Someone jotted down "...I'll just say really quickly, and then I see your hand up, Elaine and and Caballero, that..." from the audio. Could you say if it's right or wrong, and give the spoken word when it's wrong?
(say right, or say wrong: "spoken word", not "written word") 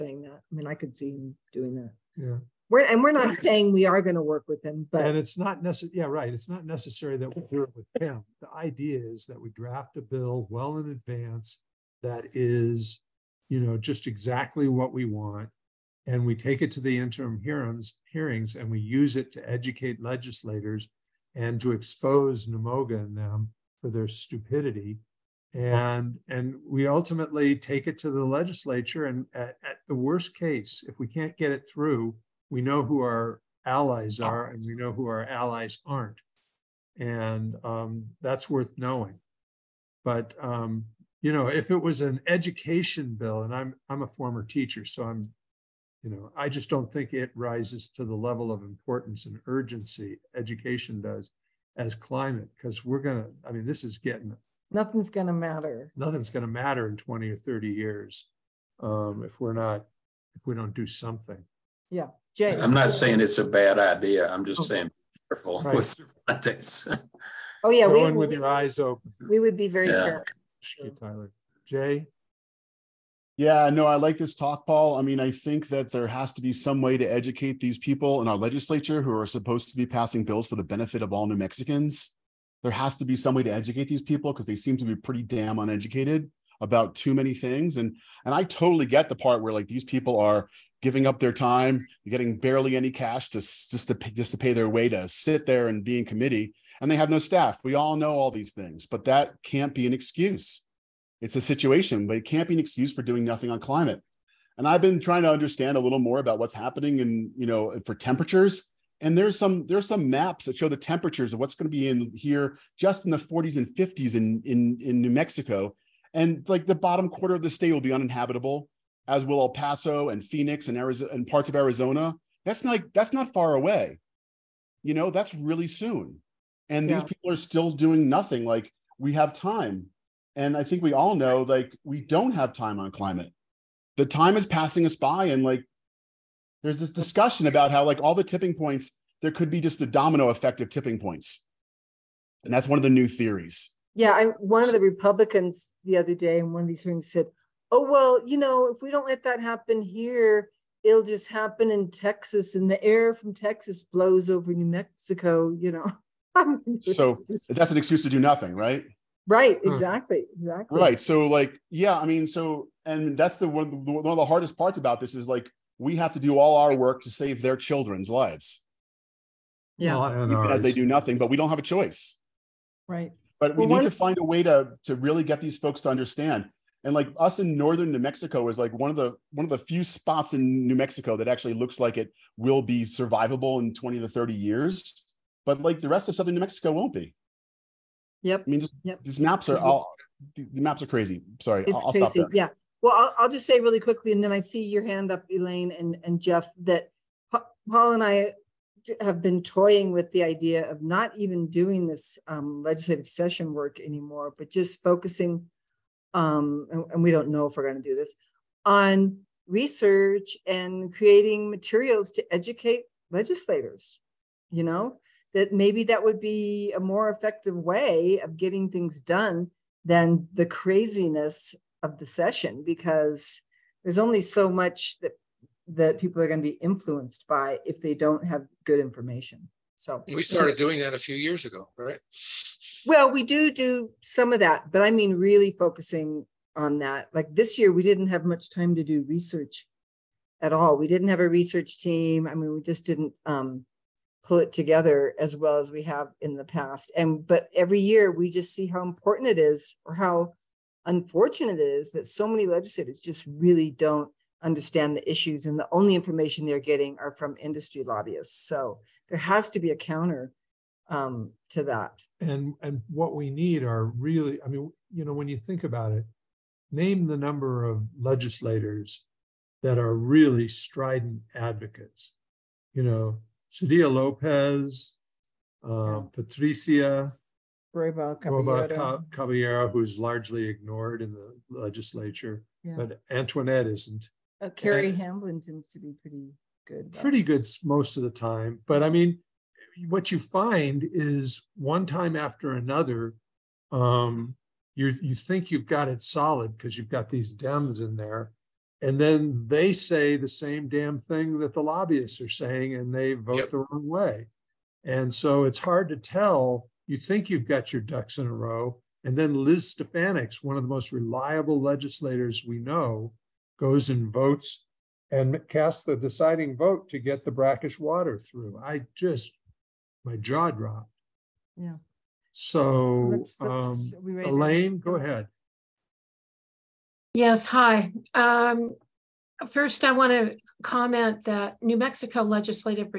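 wrong: "Jeff", not "Caballero".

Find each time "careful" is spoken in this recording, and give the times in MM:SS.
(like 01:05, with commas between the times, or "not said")
01:05, 01:10.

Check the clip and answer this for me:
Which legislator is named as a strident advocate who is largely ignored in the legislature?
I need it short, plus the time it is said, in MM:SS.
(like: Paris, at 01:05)
Patricia Roybal Caballero, at 04:36.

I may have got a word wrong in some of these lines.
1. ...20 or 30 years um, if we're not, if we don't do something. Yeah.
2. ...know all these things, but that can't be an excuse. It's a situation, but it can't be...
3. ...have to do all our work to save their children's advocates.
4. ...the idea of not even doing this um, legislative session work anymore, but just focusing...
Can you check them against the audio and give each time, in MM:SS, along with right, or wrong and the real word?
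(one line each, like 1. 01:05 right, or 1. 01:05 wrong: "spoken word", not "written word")
1. 00:56 right
2. 01:37 right
3. 02:45 wrong: "lives", not "advocates"
4. 03:20 right.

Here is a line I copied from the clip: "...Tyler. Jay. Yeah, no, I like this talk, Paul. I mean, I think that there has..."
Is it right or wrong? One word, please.
right.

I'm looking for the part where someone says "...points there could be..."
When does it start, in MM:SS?
02:18.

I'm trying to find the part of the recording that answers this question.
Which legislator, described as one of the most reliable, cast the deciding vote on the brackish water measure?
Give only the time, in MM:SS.
05:09.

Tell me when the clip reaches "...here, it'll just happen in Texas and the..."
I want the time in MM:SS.
02:29.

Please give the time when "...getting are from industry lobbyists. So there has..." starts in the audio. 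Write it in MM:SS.
04:16.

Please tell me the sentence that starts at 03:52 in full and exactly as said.
Well, we do do some of that, but I mean really focusing on that.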